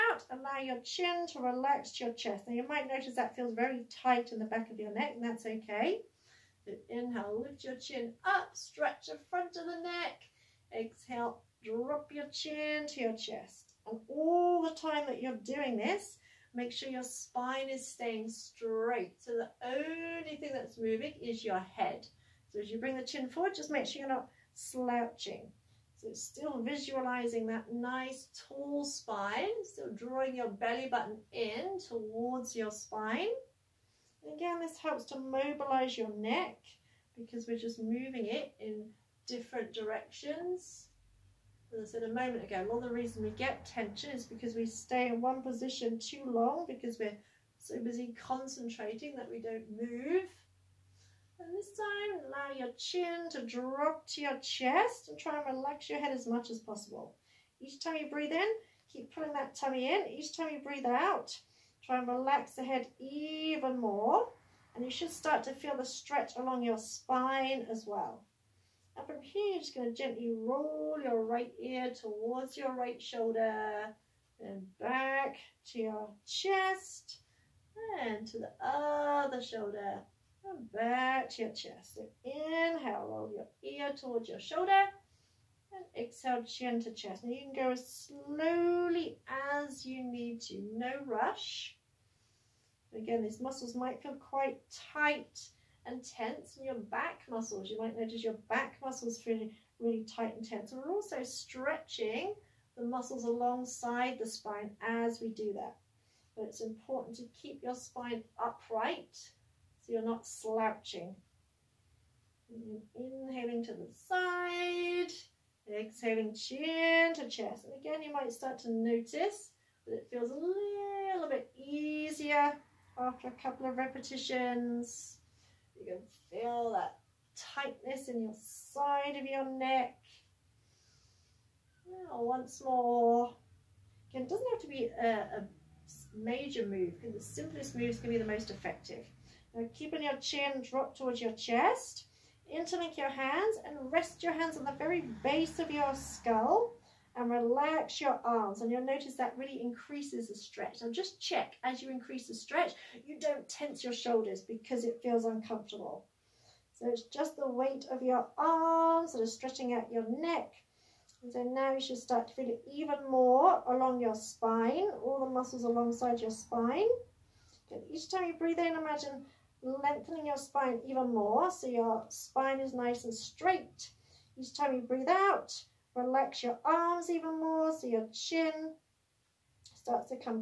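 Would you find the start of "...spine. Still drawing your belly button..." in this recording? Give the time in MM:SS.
00:28.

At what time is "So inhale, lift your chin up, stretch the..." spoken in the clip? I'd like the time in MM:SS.
00:06.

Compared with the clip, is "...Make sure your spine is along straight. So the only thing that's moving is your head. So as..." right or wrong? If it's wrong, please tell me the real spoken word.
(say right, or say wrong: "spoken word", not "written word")
wrong: "staying", not "along".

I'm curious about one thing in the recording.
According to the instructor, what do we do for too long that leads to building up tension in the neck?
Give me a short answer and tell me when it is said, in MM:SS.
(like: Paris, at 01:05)
Stay in one position, at 00:44.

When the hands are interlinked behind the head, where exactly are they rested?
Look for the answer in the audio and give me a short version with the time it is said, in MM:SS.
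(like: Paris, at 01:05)
Base of your skull, at 02:25.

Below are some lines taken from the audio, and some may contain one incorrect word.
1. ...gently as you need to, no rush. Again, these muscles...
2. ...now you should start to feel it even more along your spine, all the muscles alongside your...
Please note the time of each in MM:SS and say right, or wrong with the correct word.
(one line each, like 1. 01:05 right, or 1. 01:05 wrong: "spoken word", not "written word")
1. 01:28 wrong: "slowly", not "gently"
2. 02:41 right.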